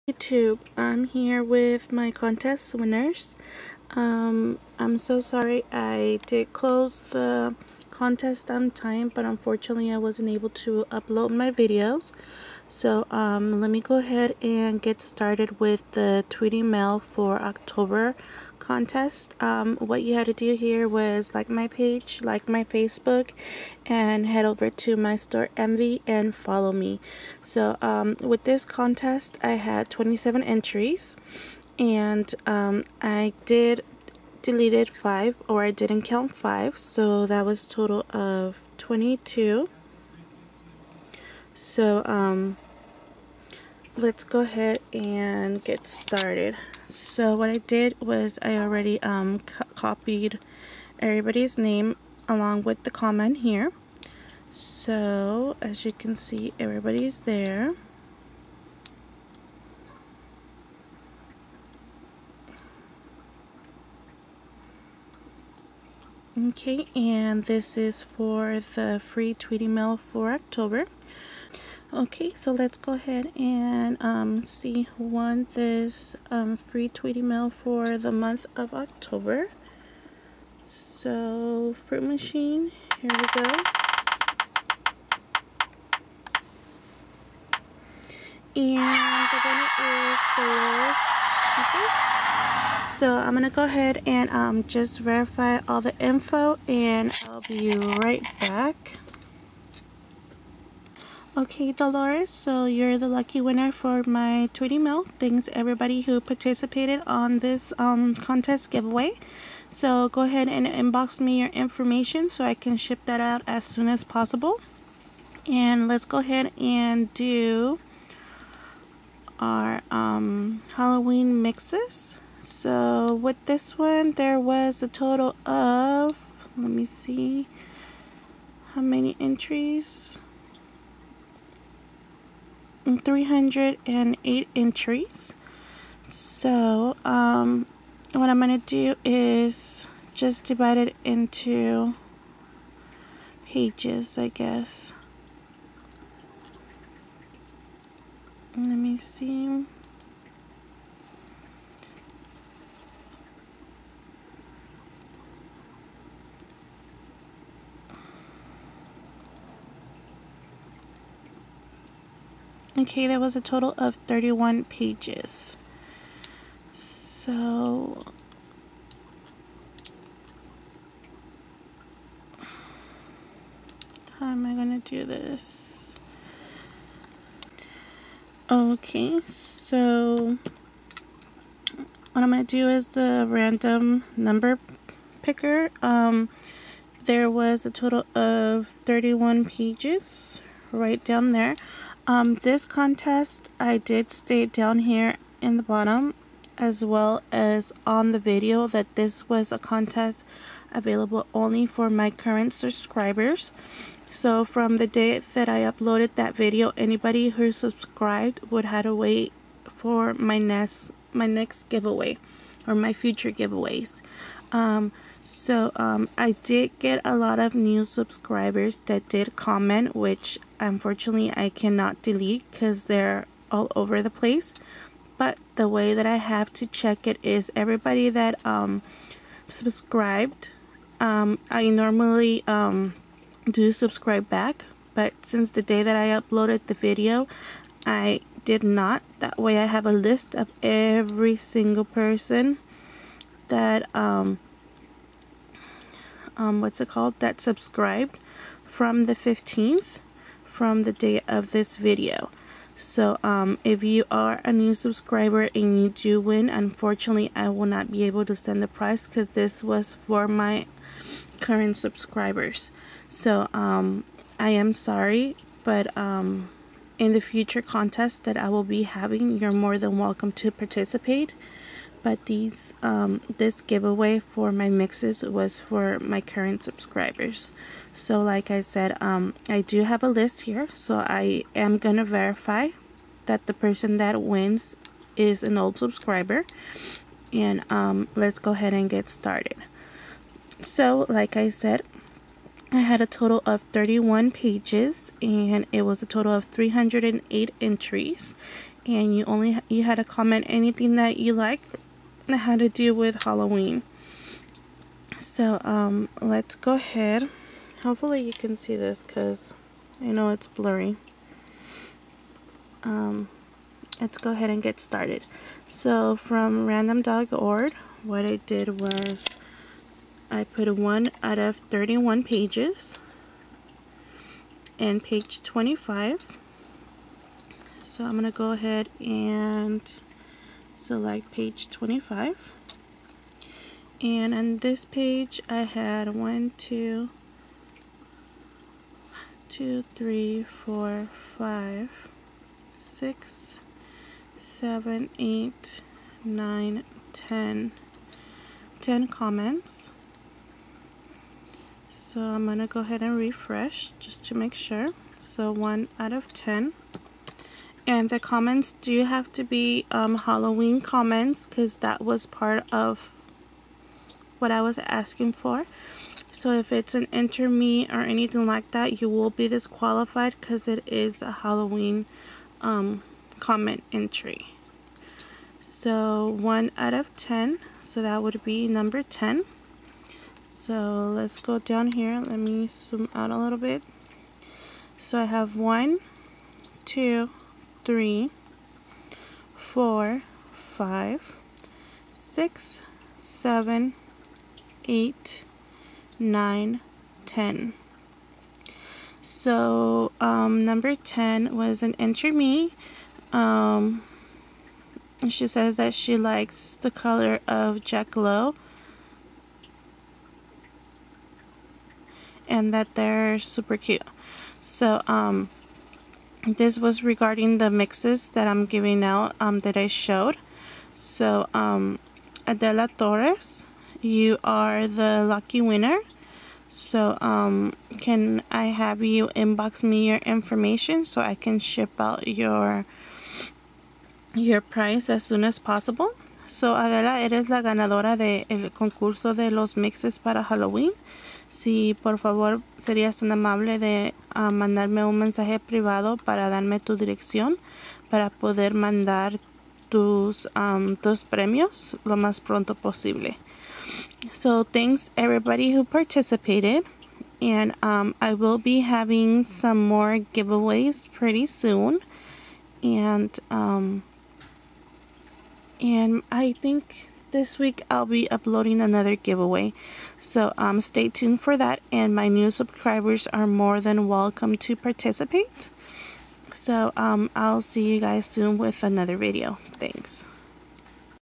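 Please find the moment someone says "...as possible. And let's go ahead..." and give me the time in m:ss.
1:53.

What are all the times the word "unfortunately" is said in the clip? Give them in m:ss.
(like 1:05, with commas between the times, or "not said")
0:09, 3:40, 4:16.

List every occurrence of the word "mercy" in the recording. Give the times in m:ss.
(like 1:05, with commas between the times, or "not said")
not said.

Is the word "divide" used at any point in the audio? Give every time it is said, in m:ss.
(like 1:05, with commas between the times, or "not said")
2:20.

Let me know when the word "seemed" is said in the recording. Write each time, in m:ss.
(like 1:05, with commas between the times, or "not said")
not said.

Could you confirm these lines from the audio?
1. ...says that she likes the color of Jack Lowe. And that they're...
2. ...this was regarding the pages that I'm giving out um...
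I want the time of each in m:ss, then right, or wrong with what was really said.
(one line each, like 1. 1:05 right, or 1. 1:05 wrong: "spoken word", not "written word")
1. 6:45 right
2. 6:56 wrong: "mixes", not "pages".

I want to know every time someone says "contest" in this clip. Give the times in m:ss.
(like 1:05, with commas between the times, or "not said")
0:02, 0:07, 0:18, 0:28, 1:48, 3:12, 3:19, 4:27.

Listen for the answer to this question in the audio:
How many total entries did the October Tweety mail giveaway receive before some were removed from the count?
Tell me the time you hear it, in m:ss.
0:29.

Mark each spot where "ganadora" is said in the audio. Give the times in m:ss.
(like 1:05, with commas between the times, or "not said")
7:17.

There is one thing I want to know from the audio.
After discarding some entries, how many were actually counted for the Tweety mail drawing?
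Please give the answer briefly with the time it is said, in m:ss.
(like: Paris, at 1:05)
22, at 0:38.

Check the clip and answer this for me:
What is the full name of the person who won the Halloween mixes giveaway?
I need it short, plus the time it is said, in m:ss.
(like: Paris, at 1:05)
Adela Torres, at 7:02.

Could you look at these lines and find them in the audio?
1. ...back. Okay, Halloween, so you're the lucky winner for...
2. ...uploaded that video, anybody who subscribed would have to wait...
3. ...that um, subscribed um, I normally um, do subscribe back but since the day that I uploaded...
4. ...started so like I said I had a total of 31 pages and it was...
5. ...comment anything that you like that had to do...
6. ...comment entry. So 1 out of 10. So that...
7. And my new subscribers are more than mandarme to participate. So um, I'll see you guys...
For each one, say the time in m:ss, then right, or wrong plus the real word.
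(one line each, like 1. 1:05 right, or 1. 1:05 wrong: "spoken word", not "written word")
1. 1:38 wrong: "Dolores", not "Halloween"
2. 3:25 right
3. 3:48 right
4. 4:49 right
5. 5:00 right
6. 6:13 right
7. 7:51 wrong: "welcome", not "mandarme".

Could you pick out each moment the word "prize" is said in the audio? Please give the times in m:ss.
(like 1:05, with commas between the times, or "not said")
4:18, 7:14.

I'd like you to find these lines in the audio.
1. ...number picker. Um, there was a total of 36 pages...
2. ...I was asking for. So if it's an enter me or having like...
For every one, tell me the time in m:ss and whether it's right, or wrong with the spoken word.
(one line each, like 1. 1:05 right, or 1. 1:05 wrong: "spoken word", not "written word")
1. 3:04 wrong: "31", not "36"
2. 6:04 wrong: "anything", not "having".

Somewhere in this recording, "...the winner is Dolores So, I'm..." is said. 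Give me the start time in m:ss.
1:29.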